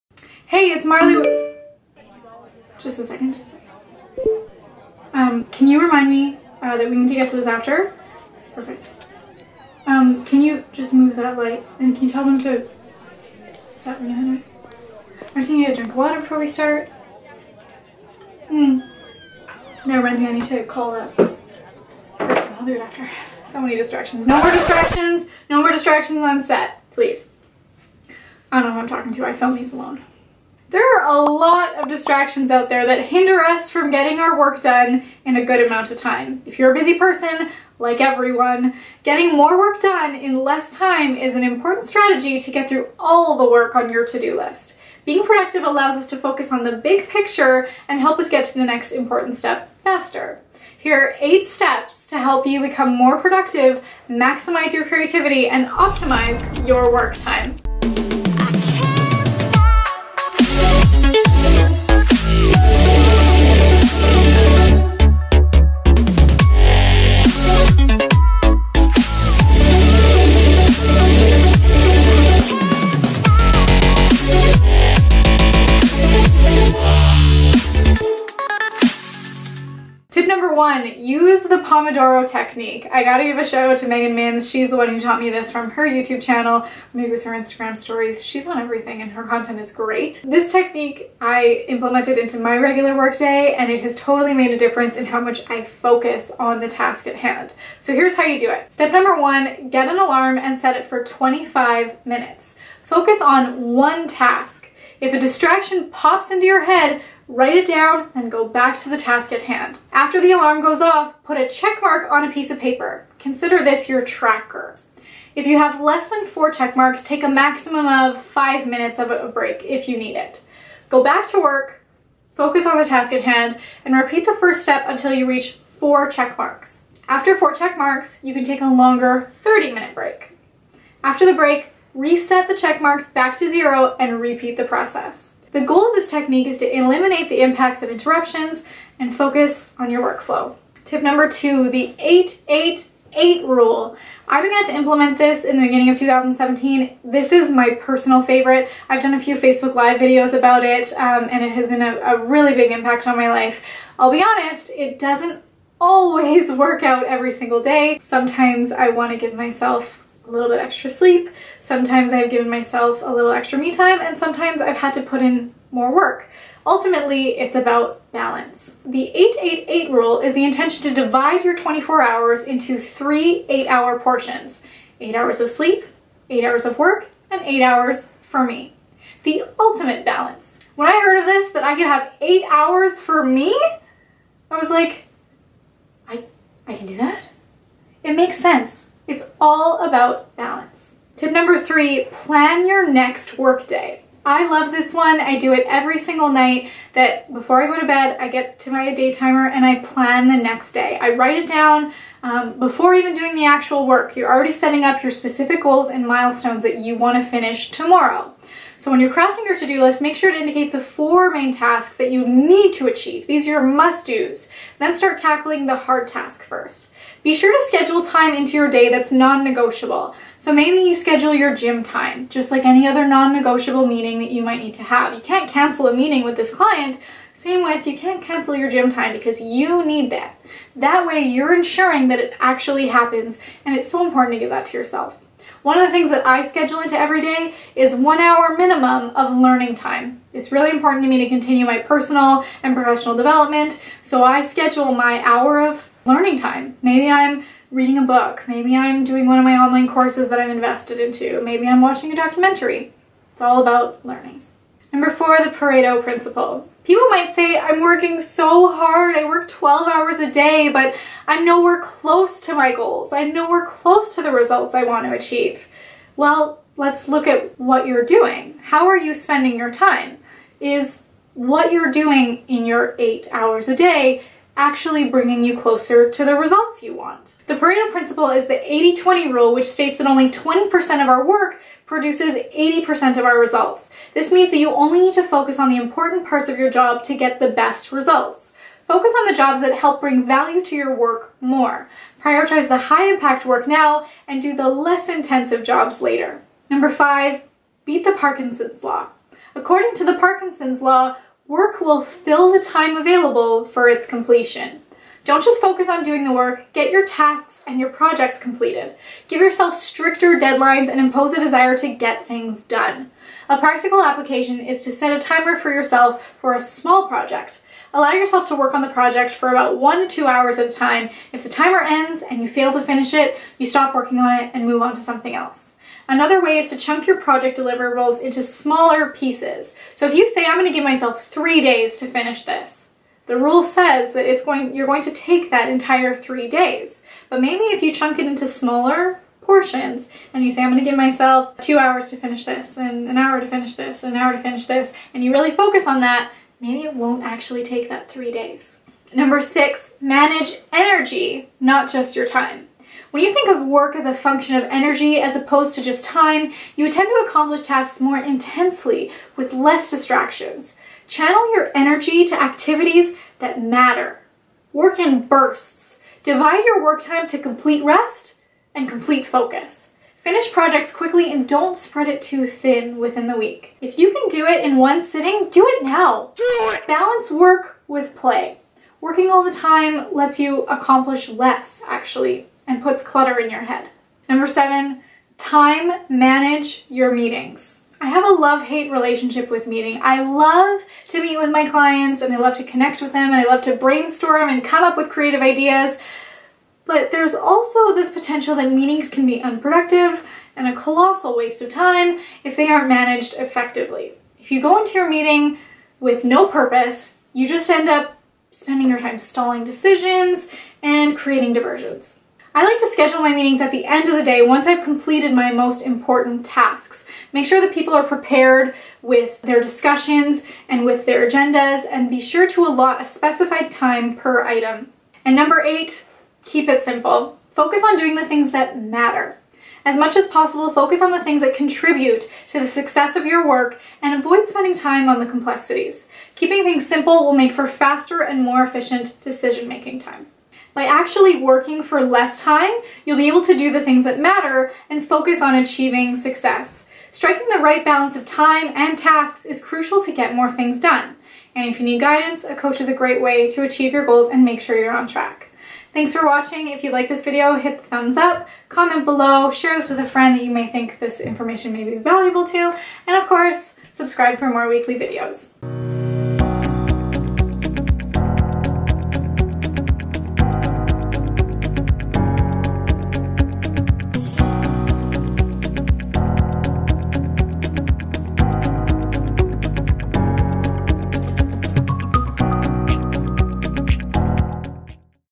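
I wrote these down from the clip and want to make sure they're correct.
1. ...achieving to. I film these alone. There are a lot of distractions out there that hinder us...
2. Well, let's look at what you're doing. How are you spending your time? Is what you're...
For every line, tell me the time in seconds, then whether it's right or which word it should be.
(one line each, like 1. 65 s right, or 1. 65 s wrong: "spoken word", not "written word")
1. 28 s wrong: "talking", not "achieving"
2. 266 s right.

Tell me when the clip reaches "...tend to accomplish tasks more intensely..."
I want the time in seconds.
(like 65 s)
356 s.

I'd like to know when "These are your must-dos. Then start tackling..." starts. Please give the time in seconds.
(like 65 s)
213 s.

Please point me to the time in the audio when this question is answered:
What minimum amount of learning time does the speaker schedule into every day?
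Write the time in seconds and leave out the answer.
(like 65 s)
237 s.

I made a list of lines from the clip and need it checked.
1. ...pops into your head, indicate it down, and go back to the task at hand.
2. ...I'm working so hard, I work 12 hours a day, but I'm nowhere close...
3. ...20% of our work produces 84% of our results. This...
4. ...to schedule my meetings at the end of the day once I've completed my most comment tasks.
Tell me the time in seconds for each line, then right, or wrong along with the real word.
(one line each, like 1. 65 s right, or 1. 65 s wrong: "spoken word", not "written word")
1. 105 s wrong: "write", not "indicate"
2. 257 s right
3. 280 s wrong: "80", not "84"
4. 412 s wrong: "important", not "comment".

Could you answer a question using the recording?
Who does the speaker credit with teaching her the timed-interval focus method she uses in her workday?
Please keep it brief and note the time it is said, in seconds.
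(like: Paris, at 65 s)
Megan Minns, at 83 s.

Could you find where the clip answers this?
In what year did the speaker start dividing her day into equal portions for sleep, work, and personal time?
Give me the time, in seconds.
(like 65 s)
145 s.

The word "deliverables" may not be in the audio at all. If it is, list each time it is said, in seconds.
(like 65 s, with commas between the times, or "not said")
327 s.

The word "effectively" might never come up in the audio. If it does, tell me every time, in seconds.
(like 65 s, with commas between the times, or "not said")
403 s.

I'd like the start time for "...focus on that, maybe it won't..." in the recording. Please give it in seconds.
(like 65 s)
345 s.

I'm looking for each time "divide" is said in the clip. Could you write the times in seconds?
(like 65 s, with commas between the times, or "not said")
170 s, 366 s.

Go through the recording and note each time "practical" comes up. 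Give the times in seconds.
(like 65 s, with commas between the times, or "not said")
313 s.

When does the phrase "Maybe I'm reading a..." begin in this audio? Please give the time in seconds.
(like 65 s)
246 s.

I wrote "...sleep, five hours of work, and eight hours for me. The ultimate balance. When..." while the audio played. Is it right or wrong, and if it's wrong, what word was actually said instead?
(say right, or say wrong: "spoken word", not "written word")
wrong: "eight", not "five".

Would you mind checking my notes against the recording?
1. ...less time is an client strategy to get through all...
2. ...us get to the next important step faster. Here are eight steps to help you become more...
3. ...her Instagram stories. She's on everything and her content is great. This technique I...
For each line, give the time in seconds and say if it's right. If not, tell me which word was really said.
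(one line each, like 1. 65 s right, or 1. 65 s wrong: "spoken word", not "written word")
1. 40 s wrong: "important", not "client"
2. 48 s right
3. 87 s right.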